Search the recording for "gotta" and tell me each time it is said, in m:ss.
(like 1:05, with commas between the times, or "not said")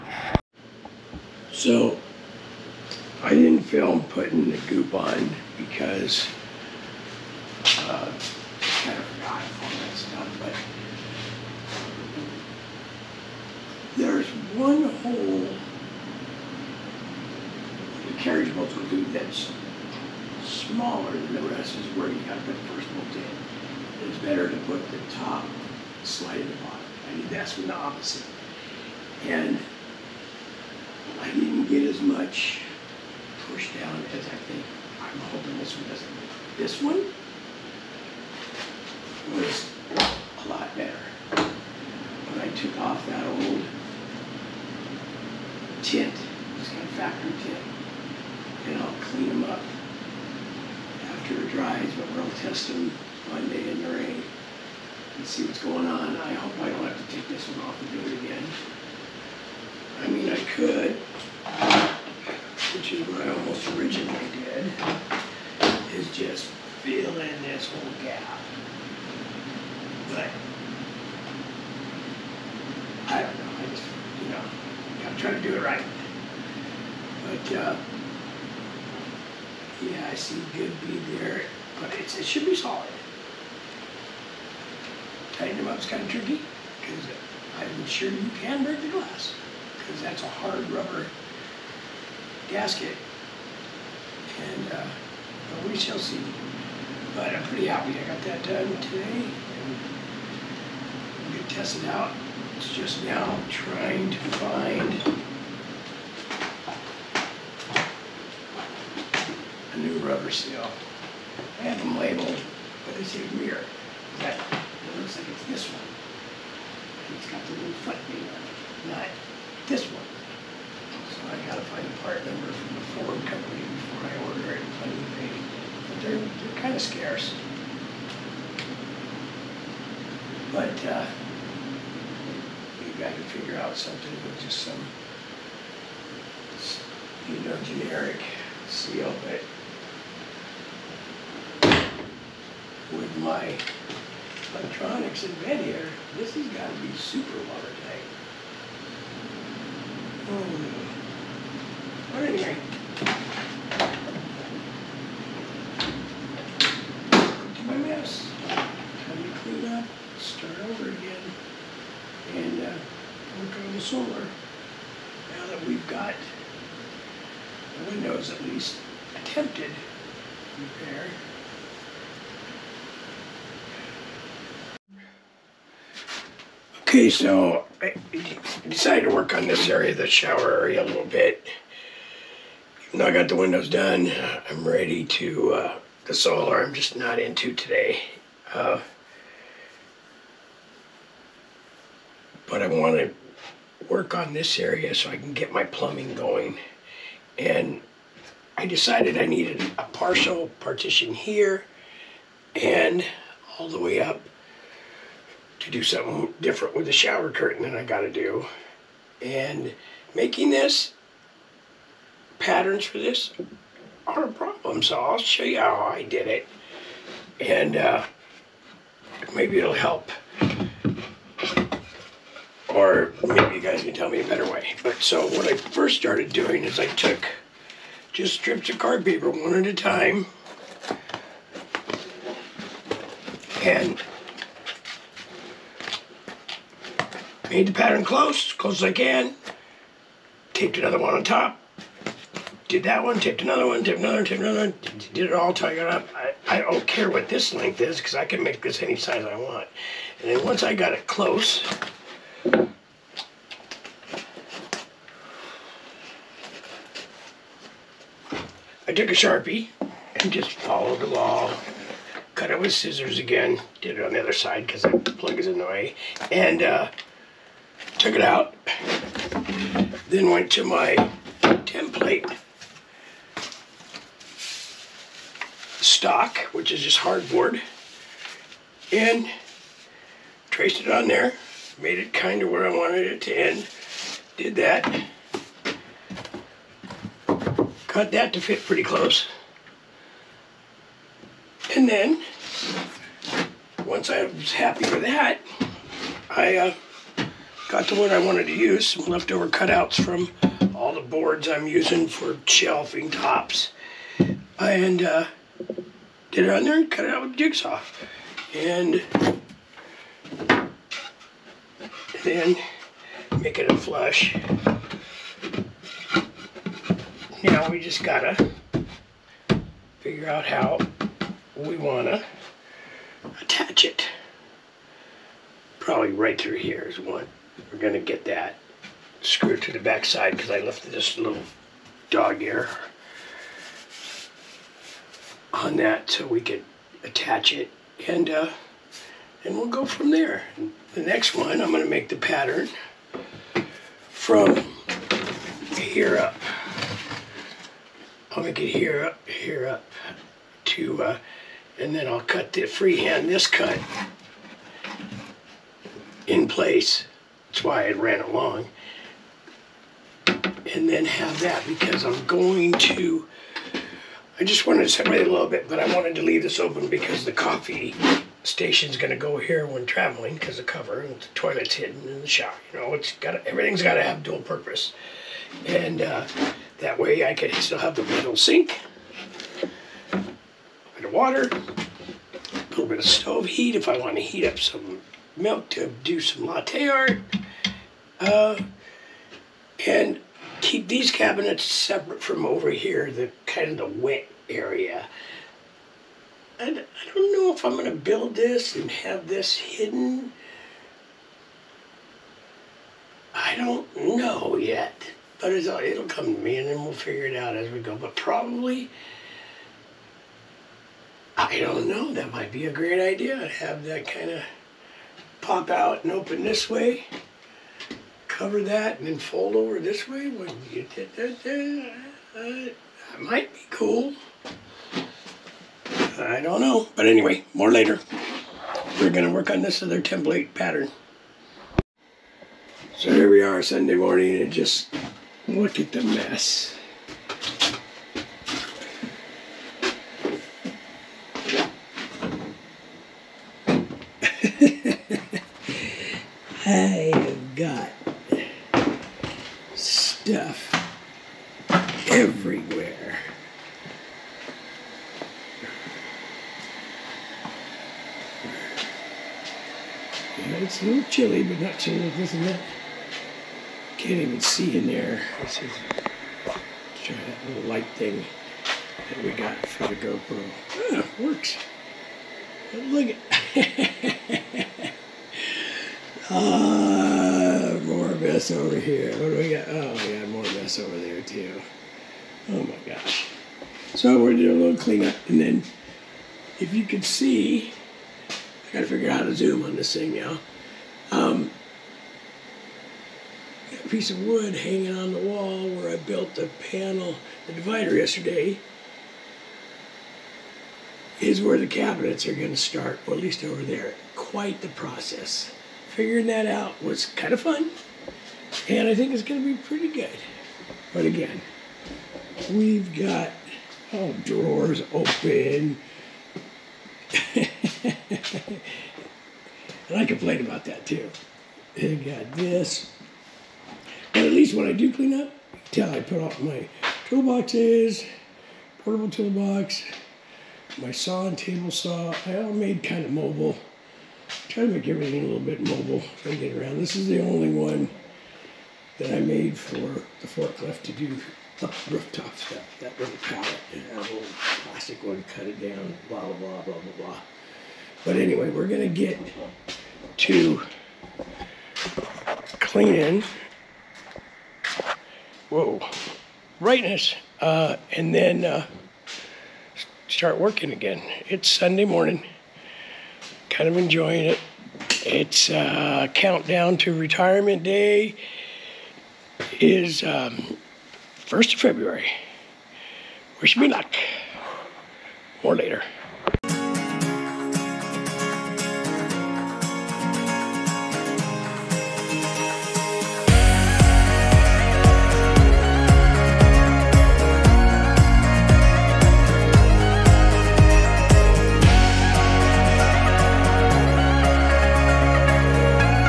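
0:22, 2:01, 5:18, 8:08.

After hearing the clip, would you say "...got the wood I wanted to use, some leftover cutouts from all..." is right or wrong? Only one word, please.
right.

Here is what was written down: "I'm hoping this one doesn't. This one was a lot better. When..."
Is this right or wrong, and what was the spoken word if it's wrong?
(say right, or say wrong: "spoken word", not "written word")
right.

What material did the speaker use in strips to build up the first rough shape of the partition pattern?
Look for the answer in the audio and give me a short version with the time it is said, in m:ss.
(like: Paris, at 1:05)
card paper, at 3:48.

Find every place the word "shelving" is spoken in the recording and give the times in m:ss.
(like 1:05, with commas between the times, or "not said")
5:02.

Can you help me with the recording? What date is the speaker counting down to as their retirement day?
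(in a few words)
February 1.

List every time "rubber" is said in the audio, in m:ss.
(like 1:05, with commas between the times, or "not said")
1:30, 1:50.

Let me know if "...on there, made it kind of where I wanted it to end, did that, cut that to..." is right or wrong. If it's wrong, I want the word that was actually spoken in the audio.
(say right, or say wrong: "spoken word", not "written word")
right.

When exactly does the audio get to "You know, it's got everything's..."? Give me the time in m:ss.
6:12.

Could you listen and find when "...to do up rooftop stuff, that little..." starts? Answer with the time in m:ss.
9:00.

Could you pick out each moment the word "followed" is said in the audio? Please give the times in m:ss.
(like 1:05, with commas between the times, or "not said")
4:20.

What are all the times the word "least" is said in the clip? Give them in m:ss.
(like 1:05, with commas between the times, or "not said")
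2:48, 8:23, 8:44.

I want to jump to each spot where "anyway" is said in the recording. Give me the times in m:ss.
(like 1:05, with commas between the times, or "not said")
7:07, 9:08.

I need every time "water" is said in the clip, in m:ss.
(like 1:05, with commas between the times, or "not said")
2:27, 6:21.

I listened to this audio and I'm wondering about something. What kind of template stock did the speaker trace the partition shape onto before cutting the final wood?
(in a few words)
hardboard.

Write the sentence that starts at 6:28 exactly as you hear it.
Uh, and keep these cabinets separate from over here, the kind of the wet area.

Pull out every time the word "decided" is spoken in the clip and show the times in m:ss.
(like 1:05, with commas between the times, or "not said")
2:58, 3:18.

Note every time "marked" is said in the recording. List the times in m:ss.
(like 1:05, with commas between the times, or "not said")
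not said.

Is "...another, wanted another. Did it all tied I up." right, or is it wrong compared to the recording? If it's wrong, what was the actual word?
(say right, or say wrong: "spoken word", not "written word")
wrong: "taped", not "wanted".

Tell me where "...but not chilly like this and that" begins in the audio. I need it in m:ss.
7:41.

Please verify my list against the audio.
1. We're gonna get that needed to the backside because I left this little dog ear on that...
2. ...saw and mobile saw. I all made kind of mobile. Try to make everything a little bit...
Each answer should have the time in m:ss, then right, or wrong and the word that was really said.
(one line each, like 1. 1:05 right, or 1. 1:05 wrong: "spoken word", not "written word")
1. 5:27 wrong: "screwed", not "needed"
2. 8:50 wrong: "table", not "mobile".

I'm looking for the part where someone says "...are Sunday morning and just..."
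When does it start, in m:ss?
7:13.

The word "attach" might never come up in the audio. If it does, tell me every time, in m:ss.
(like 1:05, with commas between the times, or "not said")
5:23, 5:37.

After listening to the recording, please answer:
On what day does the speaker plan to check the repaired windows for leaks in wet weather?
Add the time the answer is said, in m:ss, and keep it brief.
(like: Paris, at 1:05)
Monday, at 0:53.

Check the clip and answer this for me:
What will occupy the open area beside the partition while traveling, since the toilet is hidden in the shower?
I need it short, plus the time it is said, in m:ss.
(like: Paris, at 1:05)
coffee station, at 6:07.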